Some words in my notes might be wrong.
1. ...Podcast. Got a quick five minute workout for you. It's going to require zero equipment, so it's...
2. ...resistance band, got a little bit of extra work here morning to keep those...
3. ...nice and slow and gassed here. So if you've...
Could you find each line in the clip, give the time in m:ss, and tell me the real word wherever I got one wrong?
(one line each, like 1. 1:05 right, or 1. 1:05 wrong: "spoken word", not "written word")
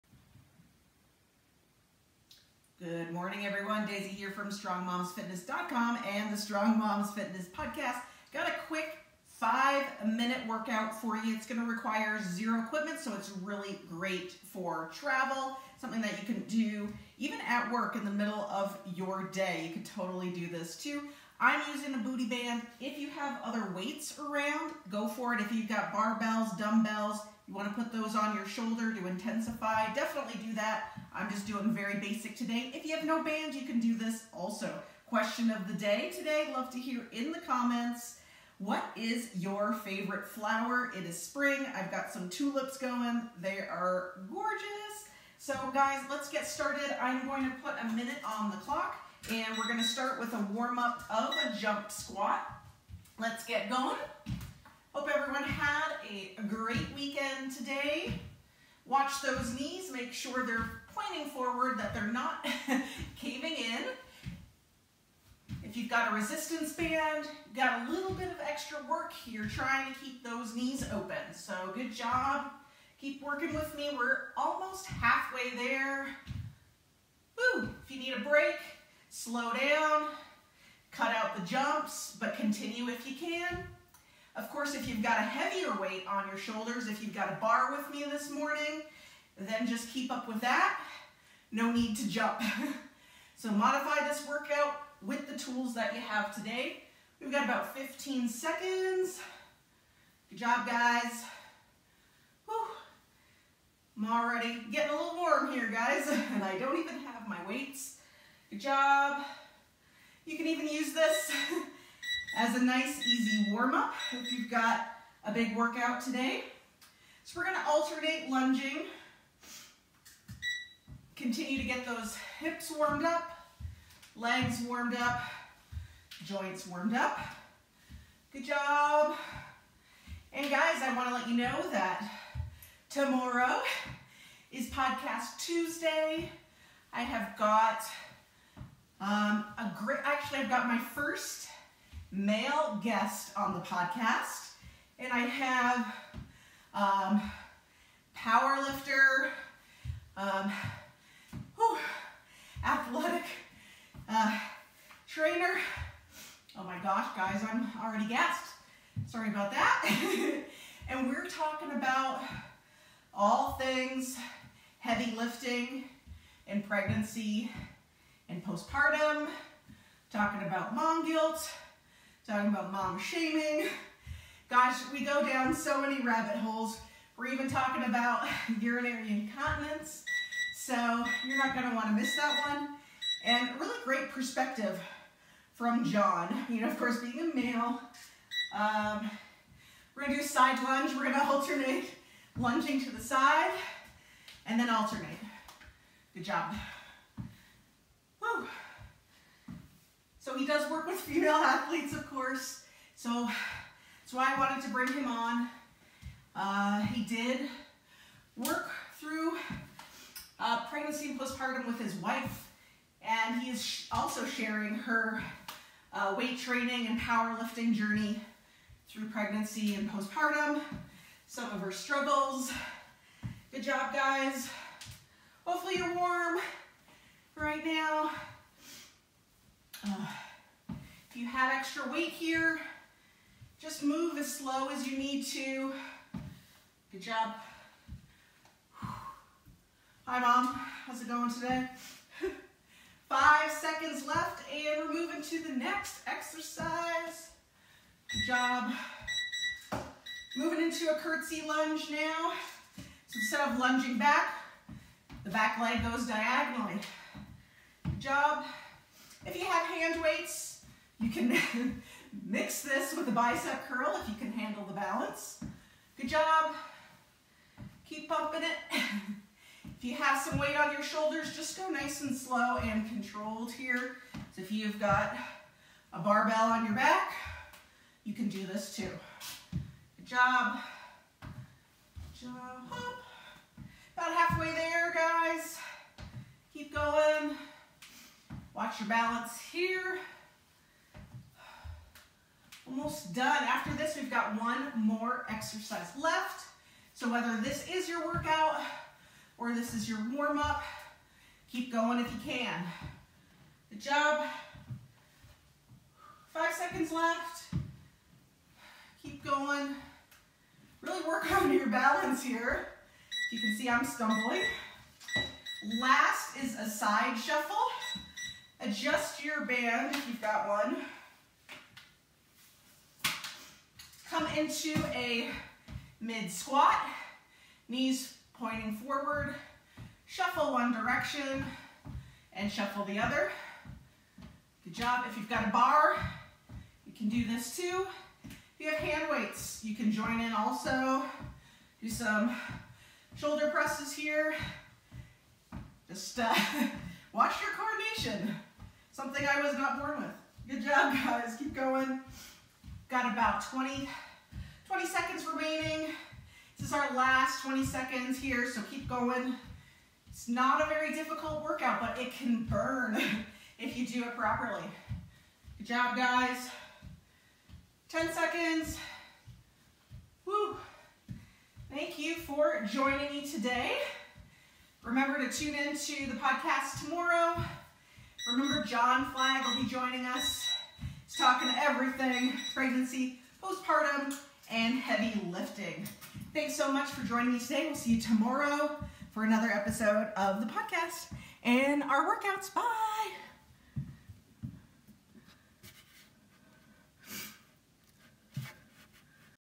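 1. 0:07 right
2. 1:06 wrong: "trying", not "morning"
3. 4:31 wrong: "controlled", not "gassed".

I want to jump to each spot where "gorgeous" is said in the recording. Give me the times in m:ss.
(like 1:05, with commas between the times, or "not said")
0:44.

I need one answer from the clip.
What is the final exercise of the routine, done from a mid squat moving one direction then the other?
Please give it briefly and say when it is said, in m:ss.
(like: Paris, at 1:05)
Side shuffle, at 5:16.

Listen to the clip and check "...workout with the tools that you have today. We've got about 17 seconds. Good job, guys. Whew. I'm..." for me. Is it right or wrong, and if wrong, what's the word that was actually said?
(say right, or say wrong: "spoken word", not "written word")
wrong: "15", not "17".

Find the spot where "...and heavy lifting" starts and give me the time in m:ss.
6:24.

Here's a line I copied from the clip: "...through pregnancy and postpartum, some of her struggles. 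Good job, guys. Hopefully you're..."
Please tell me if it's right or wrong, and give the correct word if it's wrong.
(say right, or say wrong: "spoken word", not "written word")
right.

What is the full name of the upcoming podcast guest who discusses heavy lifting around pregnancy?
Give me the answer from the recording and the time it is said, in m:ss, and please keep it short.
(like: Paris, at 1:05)
John Flagg, at 6:18.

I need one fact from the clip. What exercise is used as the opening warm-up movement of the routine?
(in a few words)
Jump squat.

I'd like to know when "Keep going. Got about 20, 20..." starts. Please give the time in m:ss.
5:51.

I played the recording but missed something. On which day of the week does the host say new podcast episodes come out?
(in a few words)
Tuesday.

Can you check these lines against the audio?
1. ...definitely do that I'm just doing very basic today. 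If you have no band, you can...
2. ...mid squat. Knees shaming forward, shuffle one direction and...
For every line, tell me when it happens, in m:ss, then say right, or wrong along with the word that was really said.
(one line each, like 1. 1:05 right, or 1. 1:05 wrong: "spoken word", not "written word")
1. 0:29 right
2. 5:25 wrong: "pointing", not "shaming".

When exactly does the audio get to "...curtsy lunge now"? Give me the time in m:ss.
4:10.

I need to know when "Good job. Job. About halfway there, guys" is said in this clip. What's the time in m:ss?
4:39.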